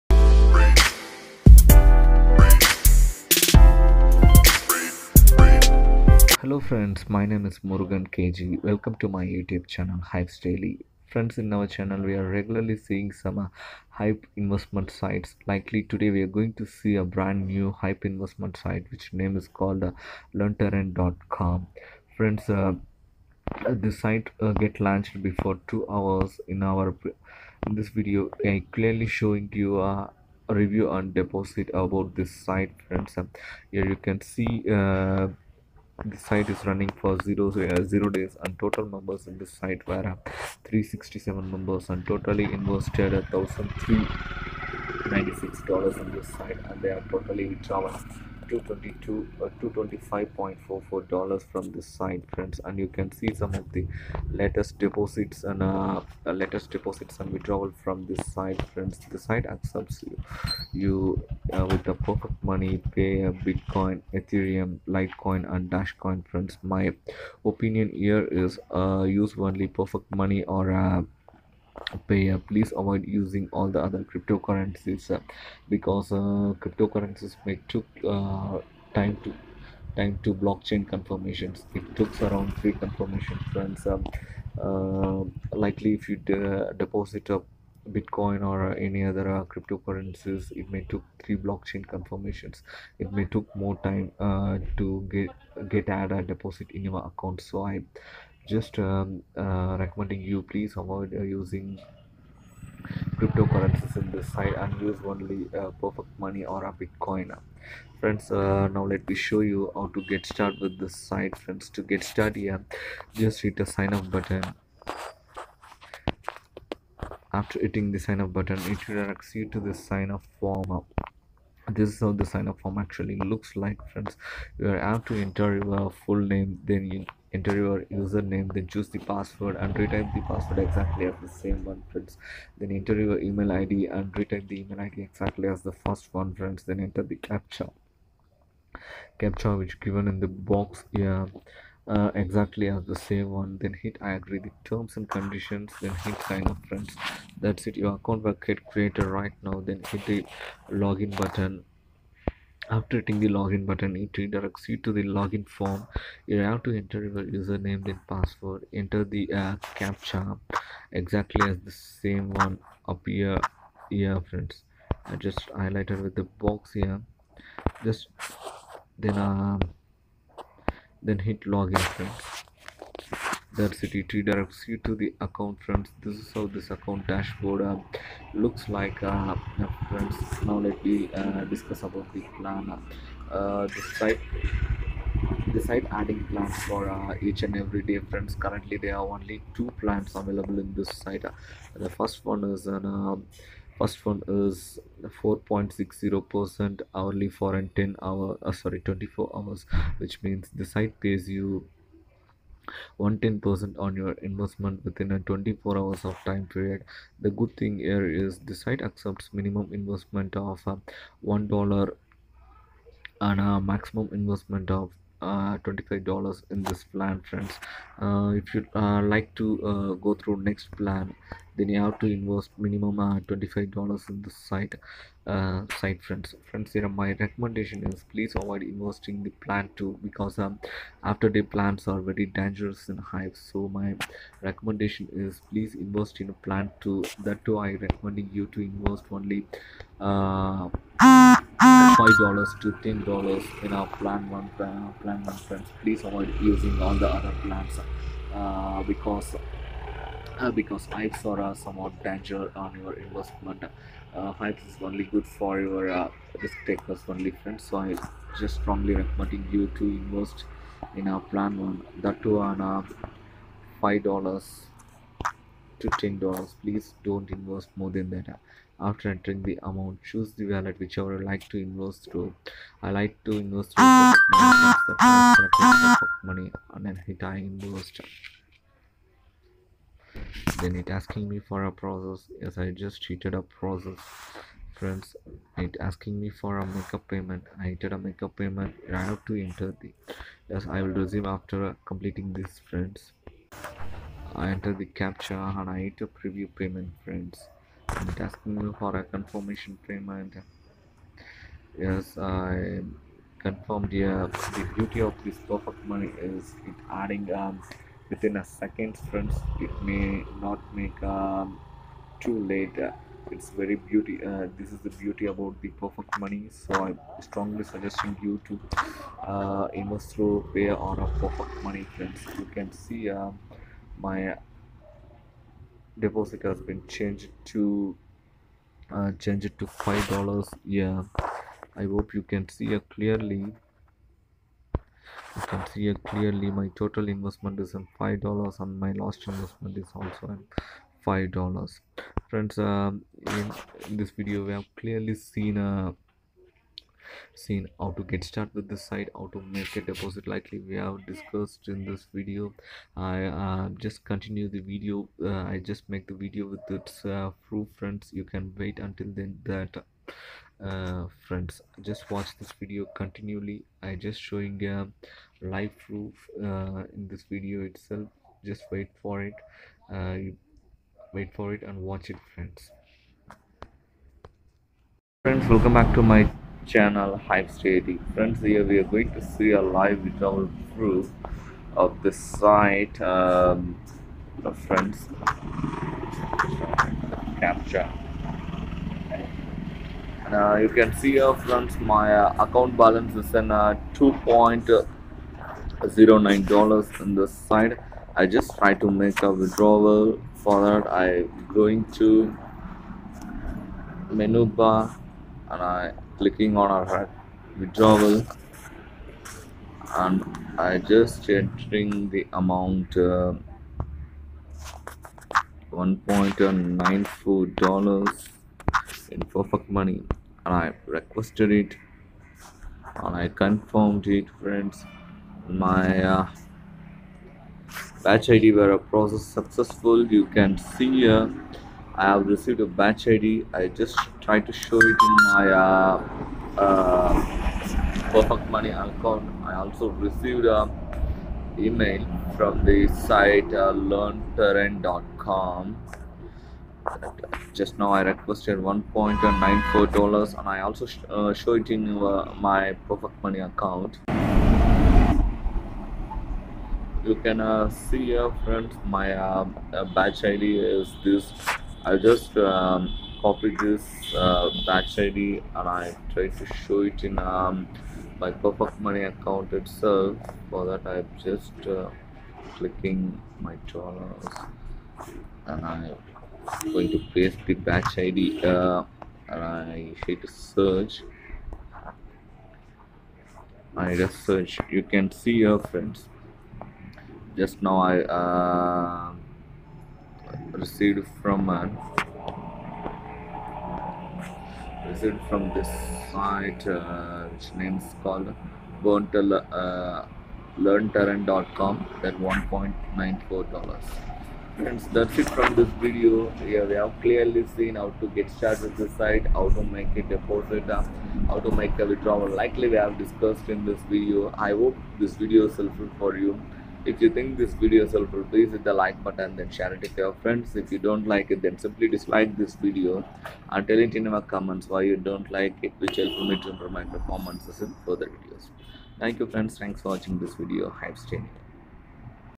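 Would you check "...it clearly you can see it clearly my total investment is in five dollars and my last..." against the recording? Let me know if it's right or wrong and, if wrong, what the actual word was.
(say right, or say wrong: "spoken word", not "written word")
right.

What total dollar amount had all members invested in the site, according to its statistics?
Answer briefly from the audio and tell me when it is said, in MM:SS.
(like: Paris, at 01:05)
$1,396, at 00:43.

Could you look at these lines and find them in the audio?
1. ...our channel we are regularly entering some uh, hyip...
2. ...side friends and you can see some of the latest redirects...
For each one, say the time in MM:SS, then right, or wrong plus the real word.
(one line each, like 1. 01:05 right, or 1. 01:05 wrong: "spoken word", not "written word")
1. 00:11 wrong: "seeing", not "entering"
2. 00:51 wrong: "deposits", not "redirects".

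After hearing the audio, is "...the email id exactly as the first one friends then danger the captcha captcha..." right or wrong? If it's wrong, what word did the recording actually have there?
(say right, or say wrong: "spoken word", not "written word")
wrong: "enter", not "danger".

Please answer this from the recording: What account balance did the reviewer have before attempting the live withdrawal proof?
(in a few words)
$2.09.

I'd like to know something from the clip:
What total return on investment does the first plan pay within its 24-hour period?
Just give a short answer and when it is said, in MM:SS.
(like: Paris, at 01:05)
110%, at 03:22.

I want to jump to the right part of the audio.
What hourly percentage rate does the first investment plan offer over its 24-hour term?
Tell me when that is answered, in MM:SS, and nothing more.
03:15.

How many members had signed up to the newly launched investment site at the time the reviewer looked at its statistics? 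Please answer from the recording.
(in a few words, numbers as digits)
367.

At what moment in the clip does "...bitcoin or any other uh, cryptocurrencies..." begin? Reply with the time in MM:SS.
01:27.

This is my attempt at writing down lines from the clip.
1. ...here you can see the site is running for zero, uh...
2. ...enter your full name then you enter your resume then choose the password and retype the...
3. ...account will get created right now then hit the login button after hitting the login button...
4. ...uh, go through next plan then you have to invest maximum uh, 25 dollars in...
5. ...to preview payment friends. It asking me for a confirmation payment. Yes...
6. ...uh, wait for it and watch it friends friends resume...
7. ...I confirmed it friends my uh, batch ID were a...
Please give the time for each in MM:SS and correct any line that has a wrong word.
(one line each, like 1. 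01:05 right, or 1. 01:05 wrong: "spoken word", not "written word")
1. 00:33 right
2. 02:05 wrong: "username", not "resume"
3. 02:27 right
4. 03:39 wrong: "minimum", not "maximum"
5. 04:55 right
6. 06:09 wrong: "welcome", not "resume"
7. 07:03 right.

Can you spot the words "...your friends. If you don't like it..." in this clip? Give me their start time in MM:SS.
08:39.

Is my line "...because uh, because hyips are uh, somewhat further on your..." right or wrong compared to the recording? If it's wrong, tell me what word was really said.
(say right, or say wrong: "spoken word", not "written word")
wrong: "danger", not "further".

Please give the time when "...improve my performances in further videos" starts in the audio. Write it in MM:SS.
08:46.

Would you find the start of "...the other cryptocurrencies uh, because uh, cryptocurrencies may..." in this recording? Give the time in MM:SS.
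01:13.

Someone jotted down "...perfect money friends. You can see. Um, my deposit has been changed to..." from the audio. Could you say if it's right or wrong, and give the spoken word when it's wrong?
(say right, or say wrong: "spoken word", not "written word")
right.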